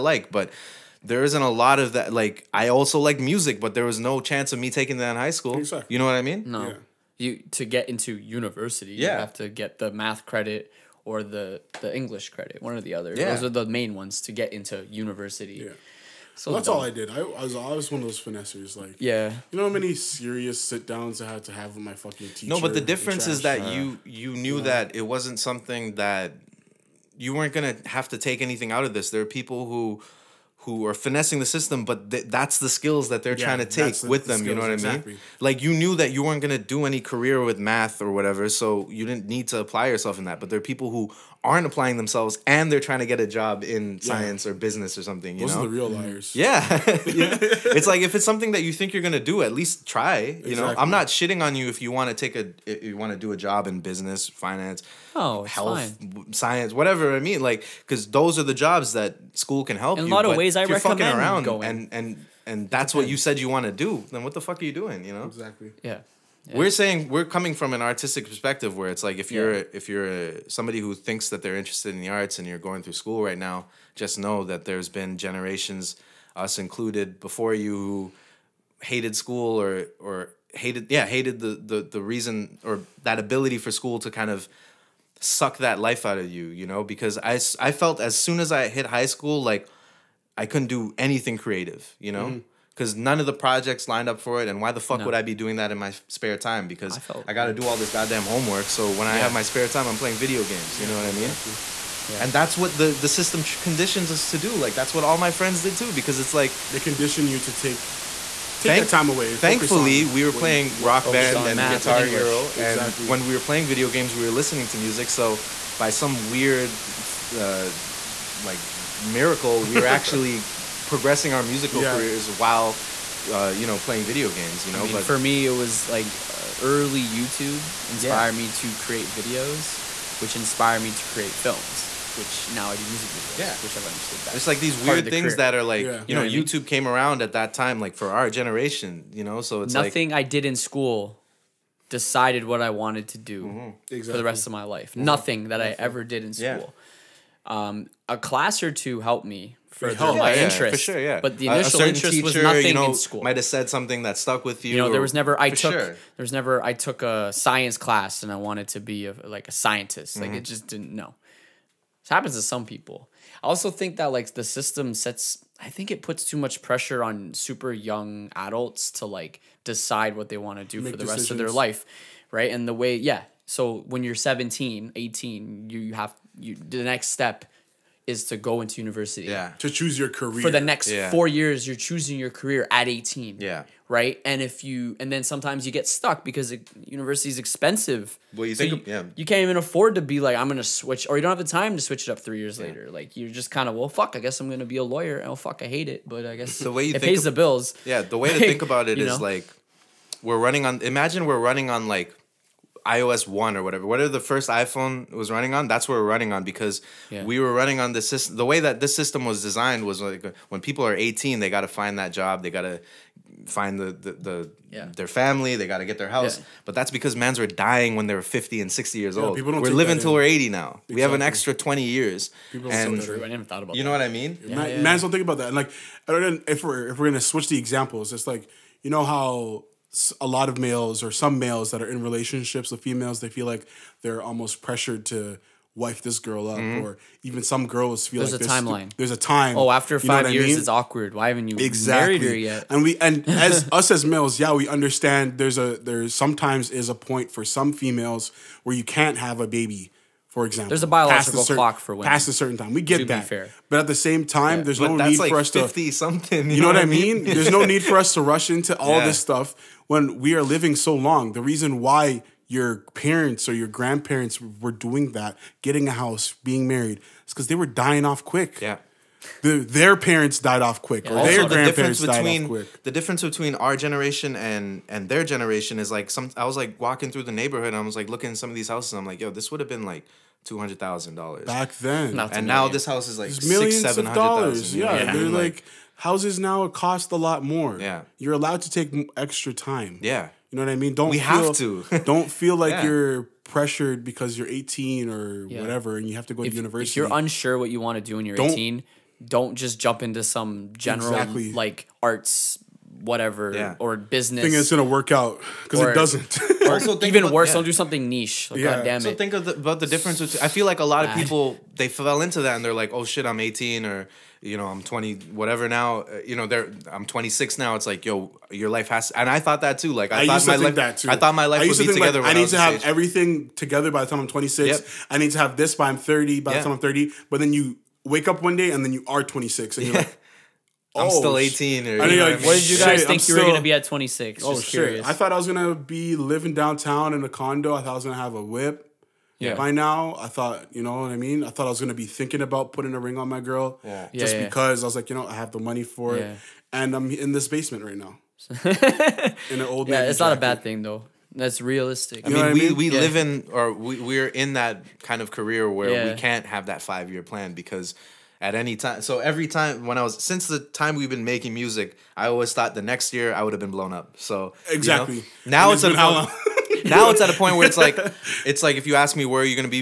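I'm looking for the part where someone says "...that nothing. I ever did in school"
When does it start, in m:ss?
2:25.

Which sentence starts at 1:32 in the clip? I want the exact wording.
Mm -hmm because none of the projects lined up for it.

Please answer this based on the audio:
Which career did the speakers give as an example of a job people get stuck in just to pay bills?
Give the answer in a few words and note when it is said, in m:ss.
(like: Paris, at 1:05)
Lawyer, at 3:14.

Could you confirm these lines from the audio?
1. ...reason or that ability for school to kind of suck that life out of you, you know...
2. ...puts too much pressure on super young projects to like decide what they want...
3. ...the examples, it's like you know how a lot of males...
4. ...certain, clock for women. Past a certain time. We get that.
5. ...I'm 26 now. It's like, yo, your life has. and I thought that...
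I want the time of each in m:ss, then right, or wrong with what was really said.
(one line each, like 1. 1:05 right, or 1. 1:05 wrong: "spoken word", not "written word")
1. 1:22 right
2. 2:46 wrong: "adults", not "projects"
3. 3:47 right
4. 4:11 right
5. 5:16 right.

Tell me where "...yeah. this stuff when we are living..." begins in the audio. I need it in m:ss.
4:18.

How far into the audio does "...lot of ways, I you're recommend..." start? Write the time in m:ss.
1:00.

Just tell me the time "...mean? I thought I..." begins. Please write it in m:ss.
5:41.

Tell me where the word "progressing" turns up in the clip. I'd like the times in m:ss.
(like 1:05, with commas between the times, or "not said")
2:00.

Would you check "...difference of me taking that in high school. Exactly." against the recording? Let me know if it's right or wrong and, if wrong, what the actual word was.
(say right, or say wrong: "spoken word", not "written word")
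wrong: "chance", not "difference".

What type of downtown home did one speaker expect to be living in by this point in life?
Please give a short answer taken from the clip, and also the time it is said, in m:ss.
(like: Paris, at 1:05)
Condo, at 5:37.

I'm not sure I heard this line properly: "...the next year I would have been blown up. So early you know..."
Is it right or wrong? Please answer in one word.
wrong.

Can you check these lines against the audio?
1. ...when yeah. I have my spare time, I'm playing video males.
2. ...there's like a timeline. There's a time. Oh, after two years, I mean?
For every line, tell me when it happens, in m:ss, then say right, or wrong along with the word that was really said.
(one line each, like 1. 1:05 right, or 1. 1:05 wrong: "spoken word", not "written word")
1. 1:38 wrong: "games", not "males"
2. 3:58 wrong: "five", not "two".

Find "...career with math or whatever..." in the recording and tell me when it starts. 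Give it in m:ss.
0:36.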